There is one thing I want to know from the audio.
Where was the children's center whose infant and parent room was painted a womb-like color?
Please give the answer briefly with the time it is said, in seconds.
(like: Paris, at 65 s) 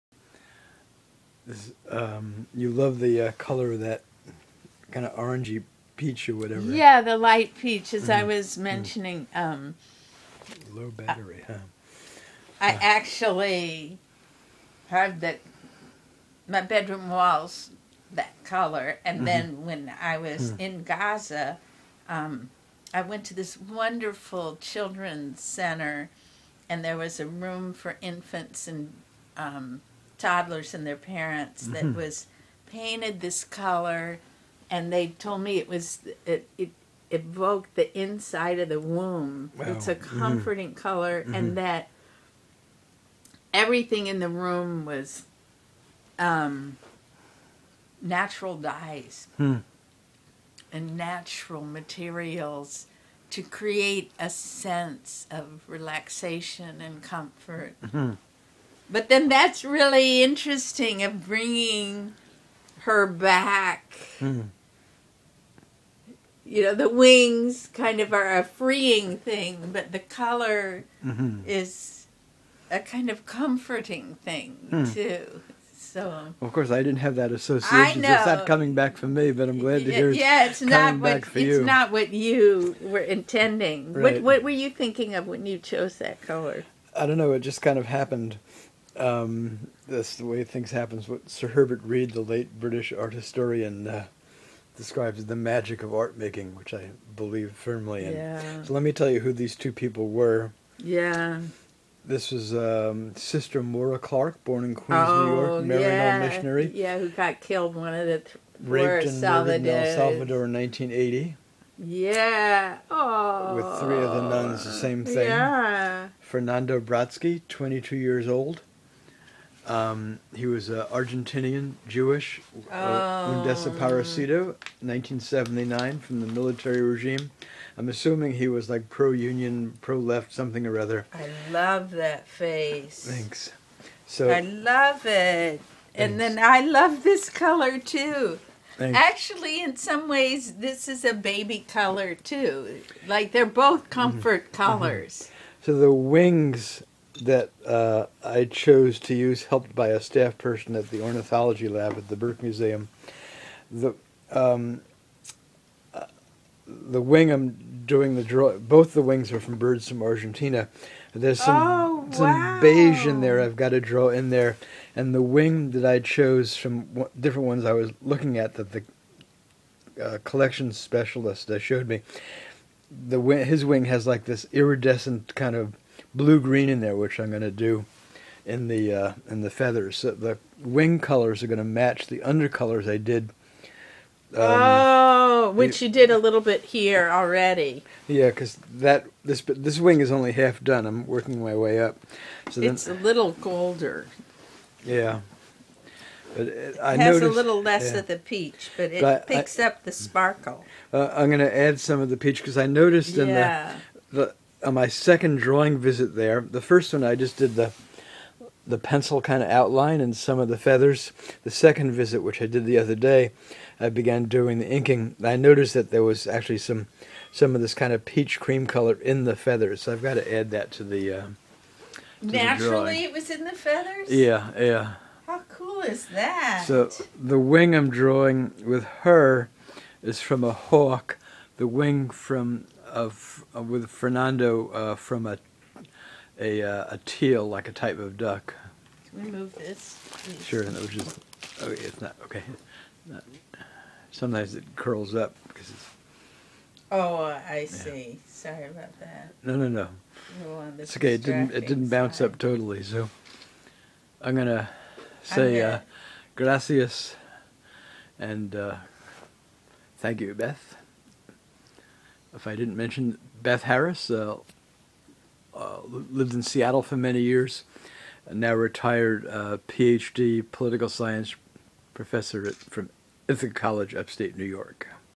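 Gaza, at 20 s.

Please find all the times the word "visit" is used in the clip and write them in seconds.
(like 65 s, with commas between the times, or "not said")
205 s, 211 s.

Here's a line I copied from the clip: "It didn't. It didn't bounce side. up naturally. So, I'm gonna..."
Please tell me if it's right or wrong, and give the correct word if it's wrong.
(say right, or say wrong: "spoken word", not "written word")
wrong: "totally", not "naturally".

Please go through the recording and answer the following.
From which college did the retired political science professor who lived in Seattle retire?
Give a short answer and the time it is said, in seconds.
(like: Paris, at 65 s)
Ithaca College, at 273 s.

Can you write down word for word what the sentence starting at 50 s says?
and natural materials to create a sense of relaxation and comfort.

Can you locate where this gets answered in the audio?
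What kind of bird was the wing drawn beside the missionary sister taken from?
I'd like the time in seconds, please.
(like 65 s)
230 s.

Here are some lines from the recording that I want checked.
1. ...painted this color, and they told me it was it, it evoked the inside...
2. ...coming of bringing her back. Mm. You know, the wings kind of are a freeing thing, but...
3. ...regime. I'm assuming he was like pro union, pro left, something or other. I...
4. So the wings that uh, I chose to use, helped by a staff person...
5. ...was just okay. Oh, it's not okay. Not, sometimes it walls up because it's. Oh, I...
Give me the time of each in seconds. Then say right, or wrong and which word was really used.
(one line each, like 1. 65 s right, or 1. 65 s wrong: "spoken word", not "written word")
1. 32 s right
2. 60 s wrong: "interesting", not "coming"
3. 126 s right
4. 145 s right
5. 240 s wrong: "curls", not "walls".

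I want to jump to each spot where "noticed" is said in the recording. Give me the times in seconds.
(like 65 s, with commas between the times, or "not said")
197 s, 202 s, 215 s.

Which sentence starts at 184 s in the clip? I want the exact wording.
Um, oh, which the, you did a little bit here already.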